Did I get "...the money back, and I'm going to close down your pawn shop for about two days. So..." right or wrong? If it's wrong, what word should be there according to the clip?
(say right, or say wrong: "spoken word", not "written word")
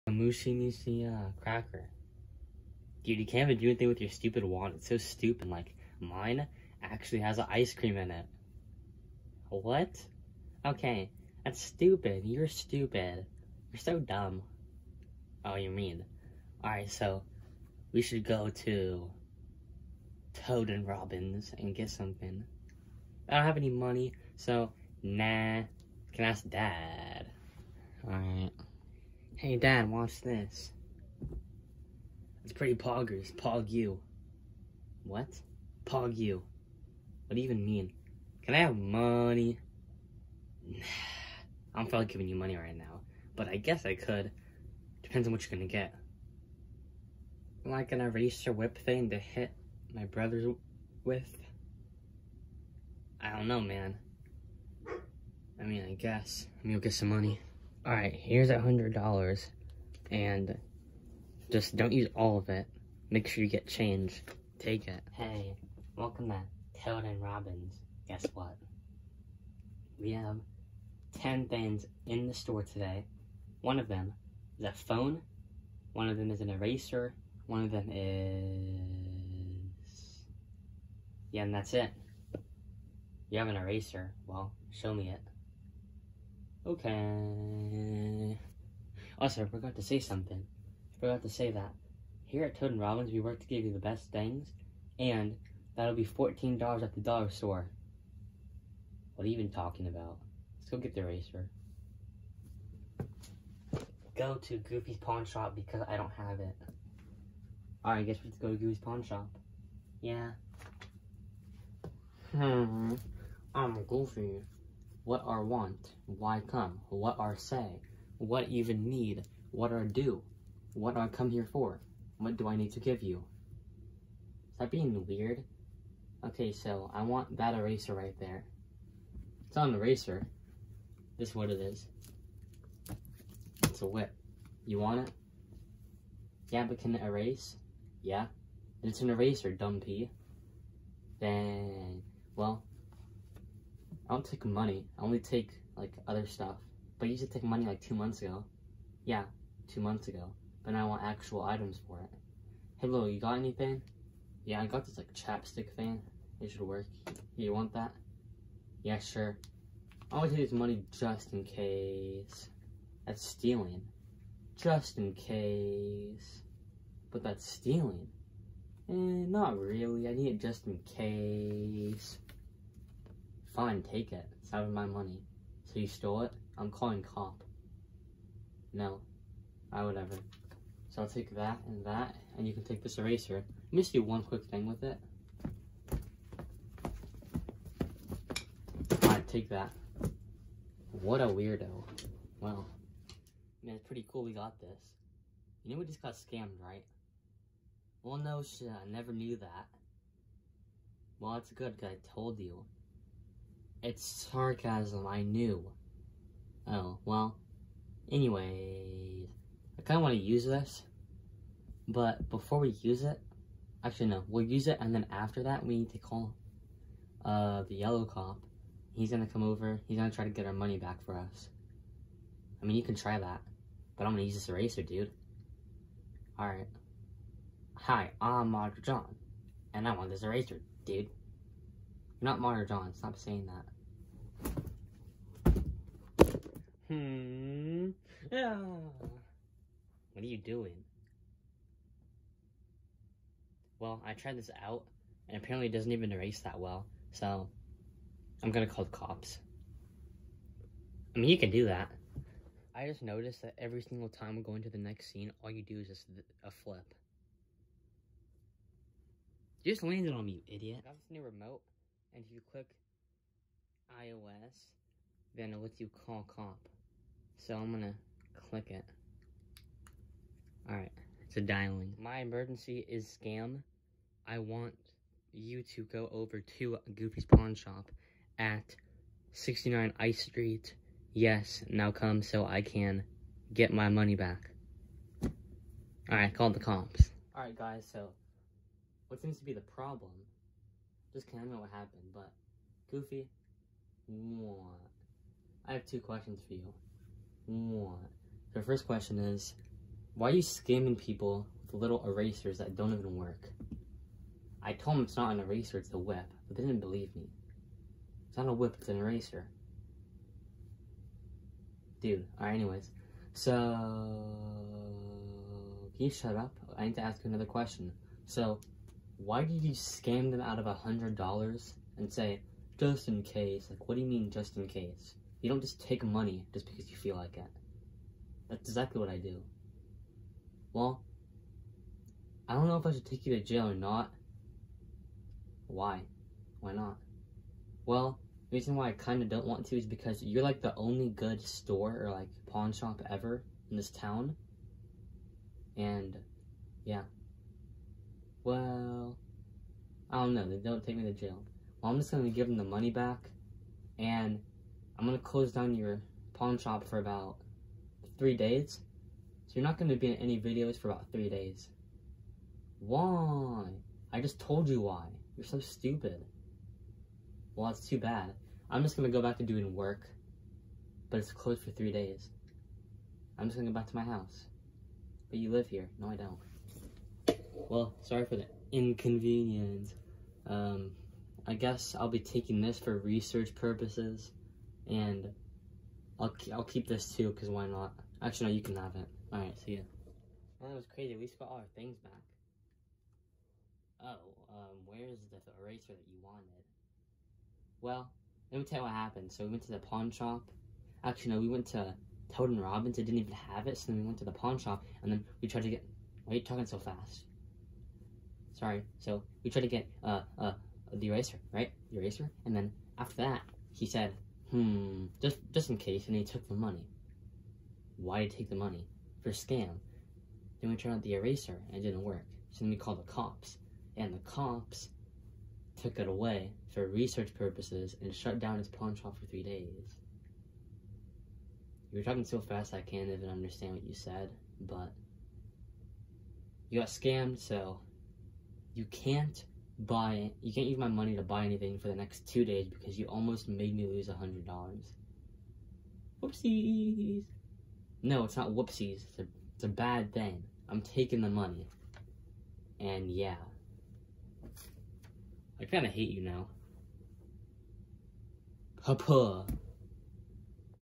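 wrong: "three", not "two".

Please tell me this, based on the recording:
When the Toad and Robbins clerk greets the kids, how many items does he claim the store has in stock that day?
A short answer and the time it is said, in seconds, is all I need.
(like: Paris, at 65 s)
10, at 71 s.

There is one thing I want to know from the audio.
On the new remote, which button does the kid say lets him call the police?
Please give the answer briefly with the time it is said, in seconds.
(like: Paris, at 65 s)
iOS, at 264 s.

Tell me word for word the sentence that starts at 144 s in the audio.
I only take like other stuff.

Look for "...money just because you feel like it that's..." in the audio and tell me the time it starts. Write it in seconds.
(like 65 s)
326 s.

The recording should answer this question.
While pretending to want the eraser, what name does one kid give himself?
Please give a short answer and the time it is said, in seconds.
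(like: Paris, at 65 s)
Roger John, at 228 s.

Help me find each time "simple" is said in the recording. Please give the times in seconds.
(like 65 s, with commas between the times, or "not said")
not said.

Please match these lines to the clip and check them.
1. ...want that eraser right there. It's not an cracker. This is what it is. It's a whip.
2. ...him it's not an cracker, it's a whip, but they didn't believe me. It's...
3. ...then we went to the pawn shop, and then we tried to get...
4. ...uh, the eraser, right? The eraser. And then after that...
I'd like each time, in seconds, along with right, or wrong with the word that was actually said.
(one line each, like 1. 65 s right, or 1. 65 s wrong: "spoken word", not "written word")
1. 127 s wrong: "eraser", not "cracker"
2. 304 s wrong: "eraser", not "cracker"
3. 403 s right
4. 410 s right.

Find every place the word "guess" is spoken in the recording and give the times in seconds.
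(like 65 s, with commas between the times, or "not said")
43 s, 55 s, 68 s, 108 s, 381 s.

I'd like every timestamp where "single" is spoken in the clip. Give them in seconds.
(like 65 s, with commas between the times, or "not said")
253 s.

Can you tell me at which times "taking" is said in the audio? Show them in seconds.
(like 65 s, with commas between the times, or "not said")
382 s, 450 s.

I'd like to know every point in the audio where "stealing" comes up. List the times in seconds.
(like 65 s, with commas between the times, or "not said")
163 s, 167 s.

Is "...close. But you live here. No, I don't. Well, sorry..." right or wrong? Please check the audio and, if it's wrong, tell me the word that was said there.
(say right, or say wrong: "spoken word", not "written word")
wrong: "house", not "close".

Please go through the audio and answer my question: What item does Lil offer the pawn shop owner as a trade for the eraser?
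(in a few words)
Chapstick.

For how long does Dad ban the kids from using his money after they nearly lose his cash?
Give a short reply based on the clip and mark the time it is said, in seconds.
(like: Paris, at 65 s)
2 days, at 441 s.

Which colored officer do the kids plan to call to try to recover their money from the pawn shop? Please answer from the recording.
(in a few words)
Yellow cop.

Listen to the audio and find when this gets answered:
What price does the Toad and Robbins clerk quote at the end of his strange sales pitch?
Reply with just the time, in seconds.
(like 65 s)
96 s.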